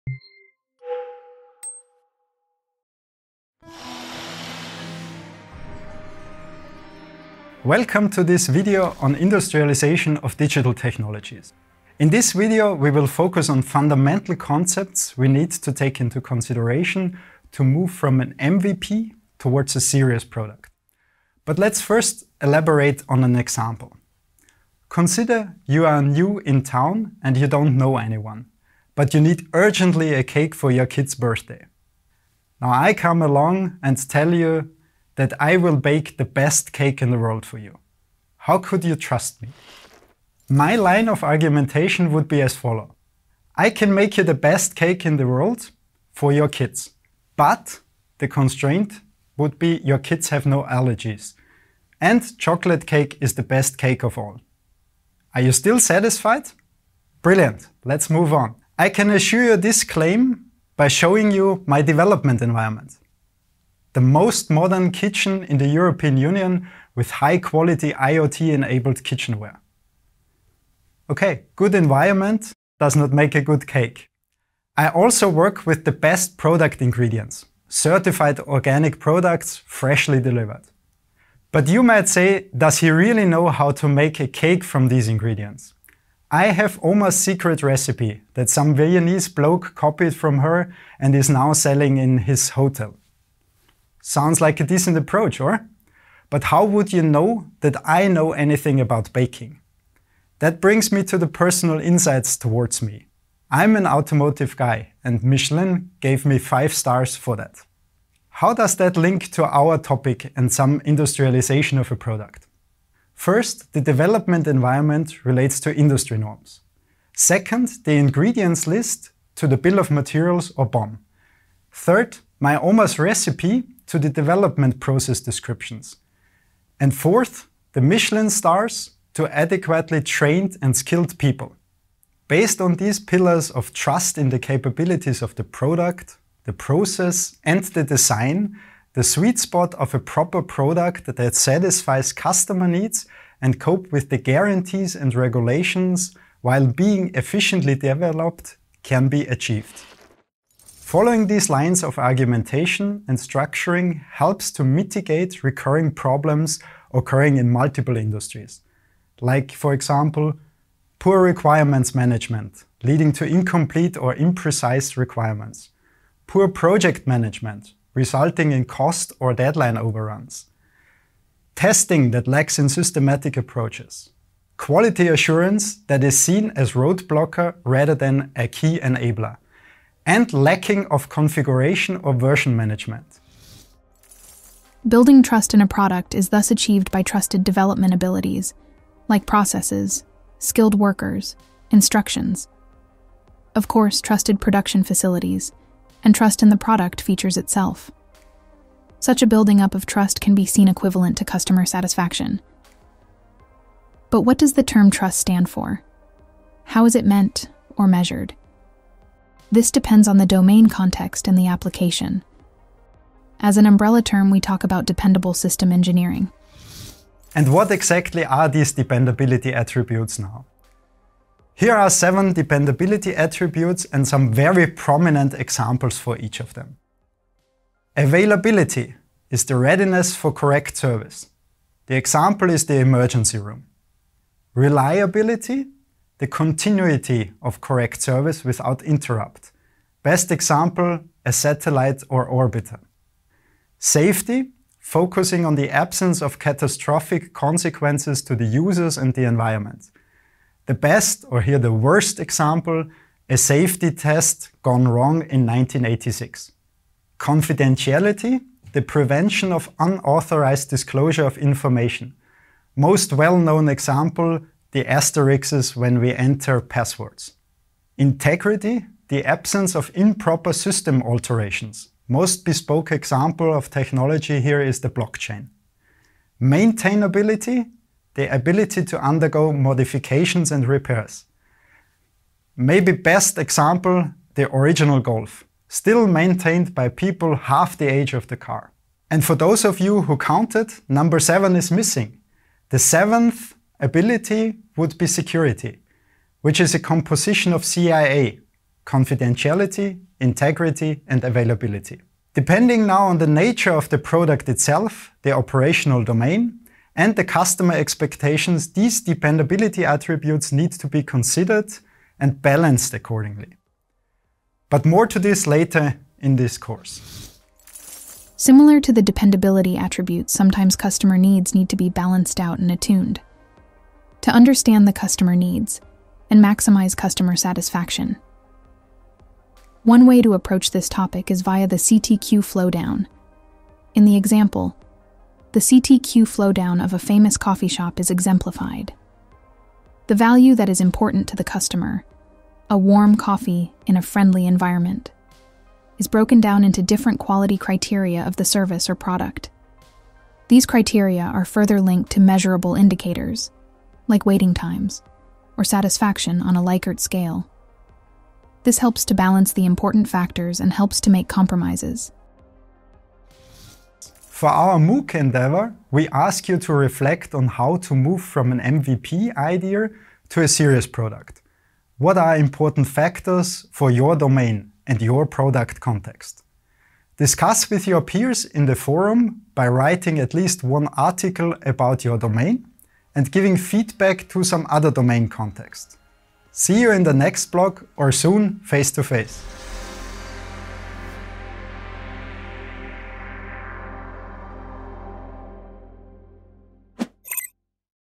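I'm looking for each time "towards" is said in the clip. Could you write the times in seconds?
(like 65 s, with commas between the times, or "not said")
19 s, 102 s.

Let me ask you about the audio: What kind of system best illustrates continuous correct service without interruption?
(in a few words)
Satellite or orbiter.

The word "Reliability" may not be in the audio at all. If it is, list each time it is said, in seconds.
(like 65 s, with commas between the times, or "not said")
234 s.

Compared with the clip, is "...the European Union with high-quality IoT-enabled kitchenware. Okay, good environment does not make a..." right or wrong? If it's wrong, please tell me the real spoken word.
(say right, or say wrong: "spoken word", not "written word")
right.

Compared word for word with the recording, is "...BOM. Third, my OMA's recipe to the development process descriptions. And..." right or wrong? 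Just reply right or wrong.
right.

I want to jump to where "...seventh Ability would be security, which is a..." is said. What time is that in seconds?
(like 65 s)
292 s.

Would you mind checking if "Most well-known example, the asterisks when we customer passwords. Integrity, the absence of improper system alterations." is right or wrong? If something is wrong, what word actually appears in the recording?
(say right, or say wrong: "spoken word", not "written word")
wrong: "enter", not "customer".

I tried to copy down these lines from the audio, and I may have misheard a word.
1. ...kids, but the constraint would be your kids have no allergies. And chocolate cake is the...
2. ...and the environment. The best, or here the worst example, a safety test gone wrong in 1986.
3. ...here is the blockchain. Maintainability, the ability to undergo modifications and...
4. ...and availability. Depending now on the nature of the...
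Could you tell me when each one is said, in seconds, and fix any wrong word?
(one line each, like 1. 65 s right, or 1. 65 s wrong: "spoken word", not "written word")
1. 46 s right
2. 248 s right
3. 274 s right
4. 301 s right.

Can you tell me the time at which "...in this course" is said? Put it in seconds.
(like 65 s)
316 s.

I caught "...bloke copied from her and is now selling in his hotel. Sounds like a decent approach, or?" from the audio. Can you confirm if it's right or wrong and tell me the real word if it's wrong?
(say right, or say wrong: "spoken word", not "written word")
right.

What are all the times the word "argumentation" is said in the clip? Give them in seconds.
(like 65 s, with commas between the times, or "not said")
41 s, 151 s.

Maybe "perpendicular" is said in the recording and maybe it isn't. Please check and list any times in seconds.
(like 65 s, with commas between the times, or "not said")
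not said.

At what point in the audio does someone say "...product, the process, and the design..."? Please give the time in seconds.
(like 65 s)
135 s.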